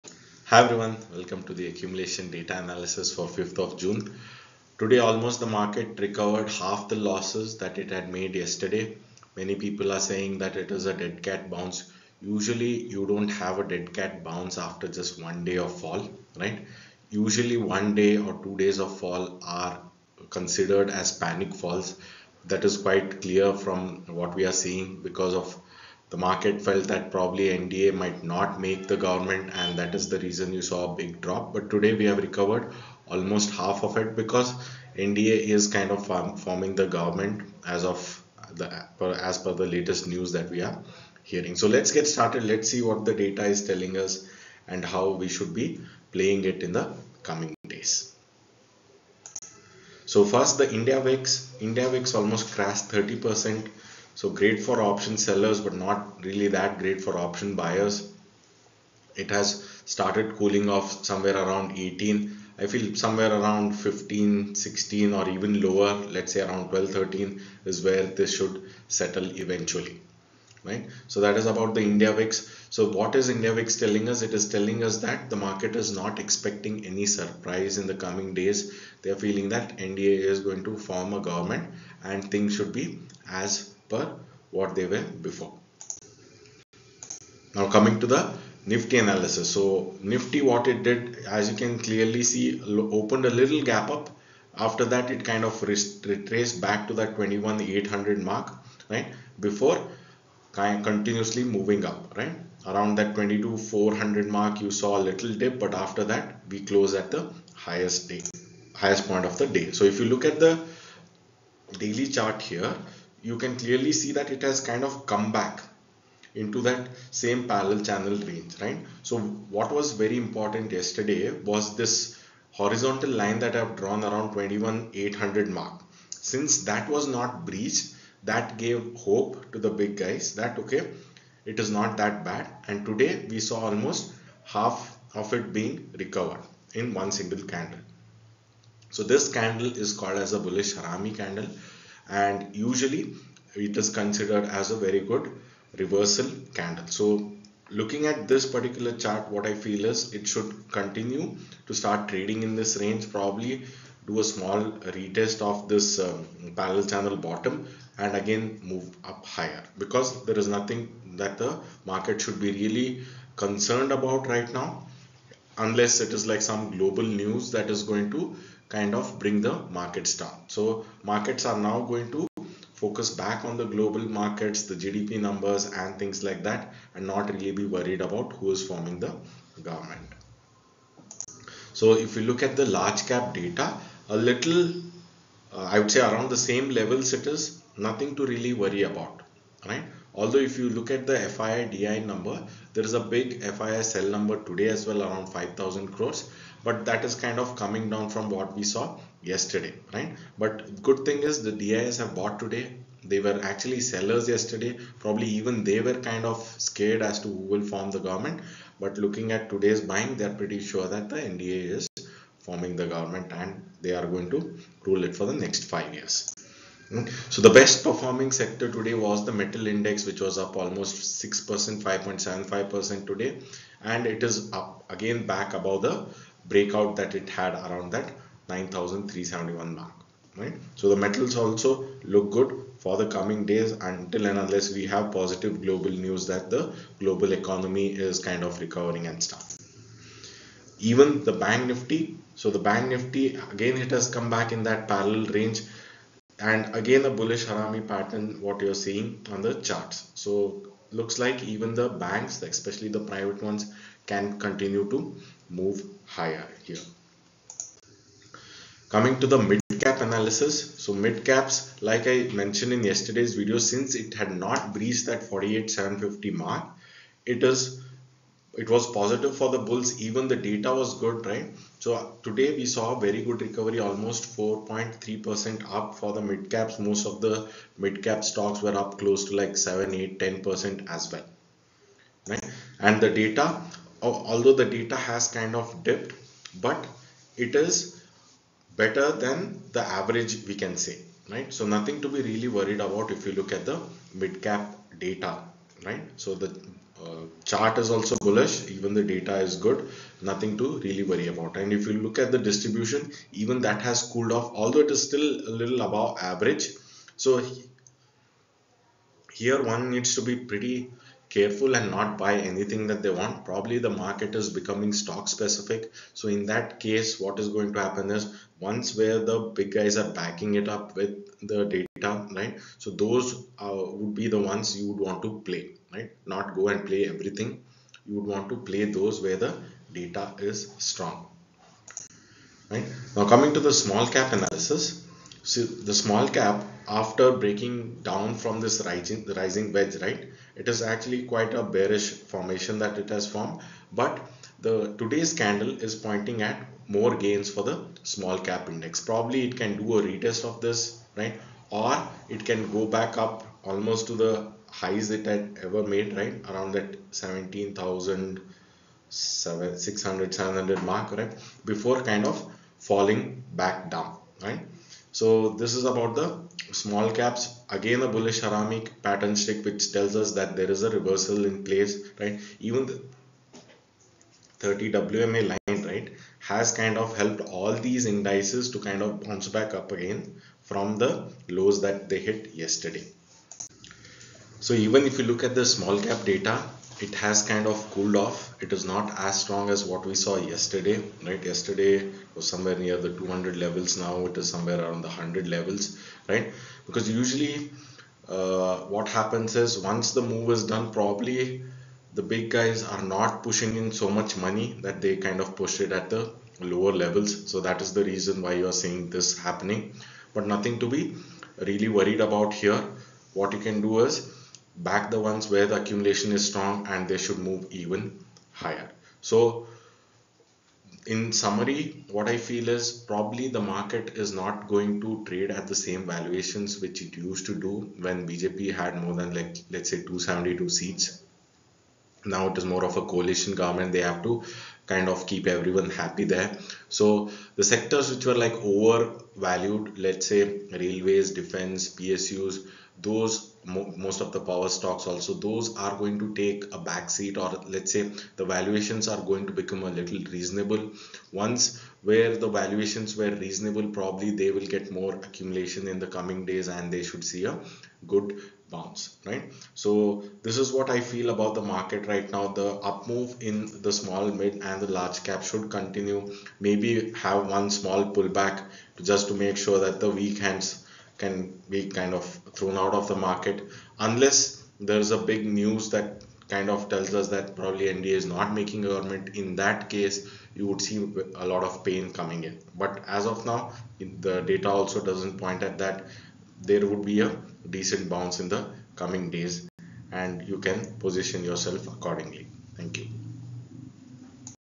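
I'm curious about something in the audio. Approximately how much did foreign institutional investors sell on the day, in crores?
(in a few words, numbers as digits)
5000 crores.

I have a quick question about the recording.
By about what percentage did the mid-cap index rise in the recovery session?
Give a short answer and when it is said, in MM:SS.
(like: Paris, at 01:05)
4.3%, at 04:34.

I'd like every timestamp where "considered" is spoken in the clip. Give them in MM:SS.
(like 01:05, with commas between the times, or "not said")
00:20, 02:23.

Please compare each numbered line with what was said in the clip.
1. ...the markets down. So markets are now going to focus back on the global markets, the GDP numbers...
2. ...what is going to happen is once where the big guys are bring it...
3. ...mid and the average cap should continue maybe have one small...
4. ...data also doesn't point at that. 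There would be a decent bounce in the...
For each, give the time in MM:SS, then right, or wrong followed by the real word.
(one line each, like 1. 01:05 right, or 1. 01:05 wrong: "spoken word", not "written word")
1. 02:49 right
2. 05:17 wrong: "backing", not "bring"
3. 07:44 wrong: "large", not "average"
4. 08:04 right.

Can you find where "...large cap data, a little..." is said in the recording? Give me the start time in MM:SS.
03:02.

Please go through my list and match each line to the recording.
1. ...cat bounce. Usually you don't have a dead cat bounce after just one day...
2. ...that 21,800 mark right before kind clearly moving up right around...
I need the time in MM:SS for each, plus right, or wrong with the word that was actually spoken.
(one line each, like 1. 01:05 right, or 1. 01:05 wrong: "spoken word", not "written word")
1. 00:11 right
2. 01:36 wrong: "continuously", not "clearly".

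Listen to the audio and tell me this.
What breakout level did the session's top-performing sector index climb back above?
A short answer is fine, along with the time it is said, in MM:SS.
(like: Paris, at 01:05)
9371, at 03:48.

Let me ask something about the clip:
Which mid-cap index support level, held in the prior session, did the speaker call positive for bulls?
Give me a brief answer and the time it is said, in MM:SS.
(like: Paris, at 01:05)
48,750, at 04:25.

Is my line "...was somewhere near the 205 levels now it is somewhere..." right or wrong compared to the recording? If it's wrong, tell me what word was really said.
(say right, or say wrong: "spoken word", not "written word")
wrong: "200", not "205".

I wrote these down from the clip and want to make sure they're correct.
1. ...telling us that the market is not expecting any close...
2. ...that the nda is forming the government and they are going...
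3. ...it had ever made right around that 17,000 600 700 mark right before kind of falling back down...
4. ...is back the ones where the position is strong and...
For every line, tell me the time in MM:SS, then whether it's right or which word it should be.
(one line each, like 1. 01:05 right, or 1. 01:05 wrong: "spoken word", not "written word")
1. 01:14 wrong: "surprise", not "close"
2. 03:30 right
3. 05:55 right
4. 06:54 wrong: "accumulation", not "position".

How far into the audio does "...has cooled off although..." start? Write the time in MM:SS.
05:03.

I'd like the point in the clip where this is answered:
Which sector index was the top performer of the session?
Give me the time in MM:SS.
03:39.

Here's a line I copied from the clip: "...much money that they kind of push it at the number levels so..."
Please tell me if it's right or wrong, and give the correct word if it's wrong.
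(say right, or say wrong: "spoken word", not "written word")
wrong: "lower", not "number".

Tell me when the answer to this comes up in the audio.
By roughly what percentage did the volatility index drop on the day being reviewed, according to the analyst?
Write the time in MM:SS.
00:52.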